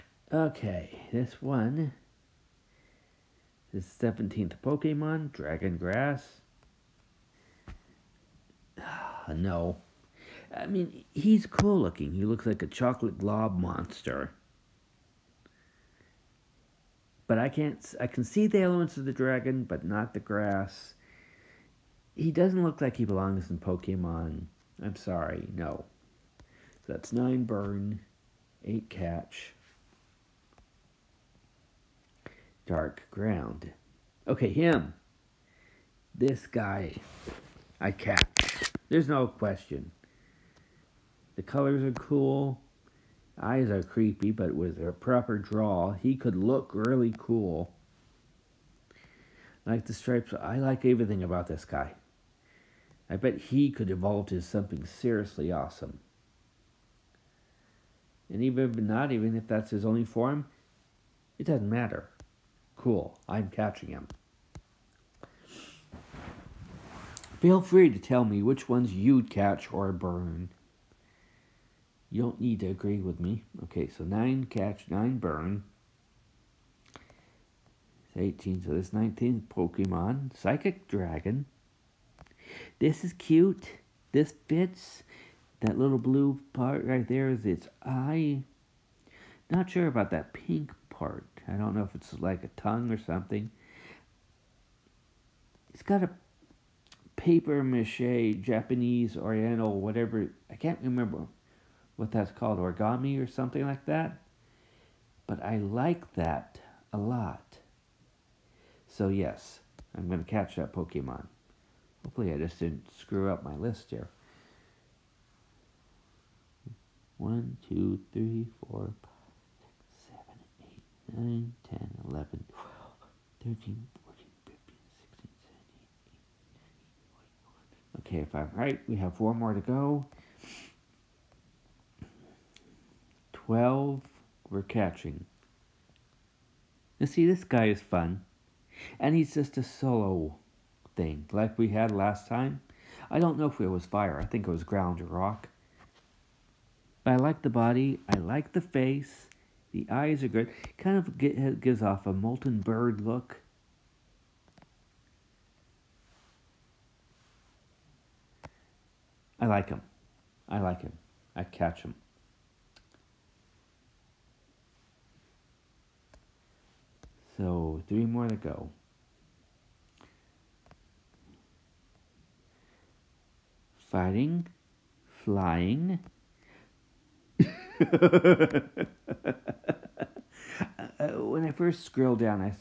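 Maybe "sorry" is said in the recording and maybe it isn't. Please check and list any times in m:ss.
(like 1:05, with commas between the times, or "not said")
0:24.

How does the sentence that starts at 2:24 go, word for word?
I think it was ground or rock.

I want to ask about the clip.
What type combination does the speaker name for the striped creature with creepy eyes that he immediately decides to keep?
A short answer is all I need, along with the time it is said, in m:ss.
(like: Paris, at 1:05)
Dark ground, at 0:32.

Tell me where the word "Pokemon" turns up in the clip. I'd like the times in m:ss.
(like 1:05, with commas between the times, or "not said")
0:04, 0:23, 1:19, 1:50.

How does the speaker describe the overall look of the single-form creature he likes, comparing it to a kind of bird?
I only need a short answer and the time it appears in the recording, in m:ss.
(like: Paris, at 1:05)
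Molten bird, at 2:32.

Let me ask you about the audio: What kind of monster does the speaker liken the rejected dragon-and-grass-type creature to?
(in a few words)
Chocolate glob monster.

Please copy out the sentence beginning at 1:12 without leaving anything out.
You don't need to agree with me.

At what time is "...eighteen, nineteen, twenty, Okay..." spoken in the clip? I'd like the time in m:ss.
2:07.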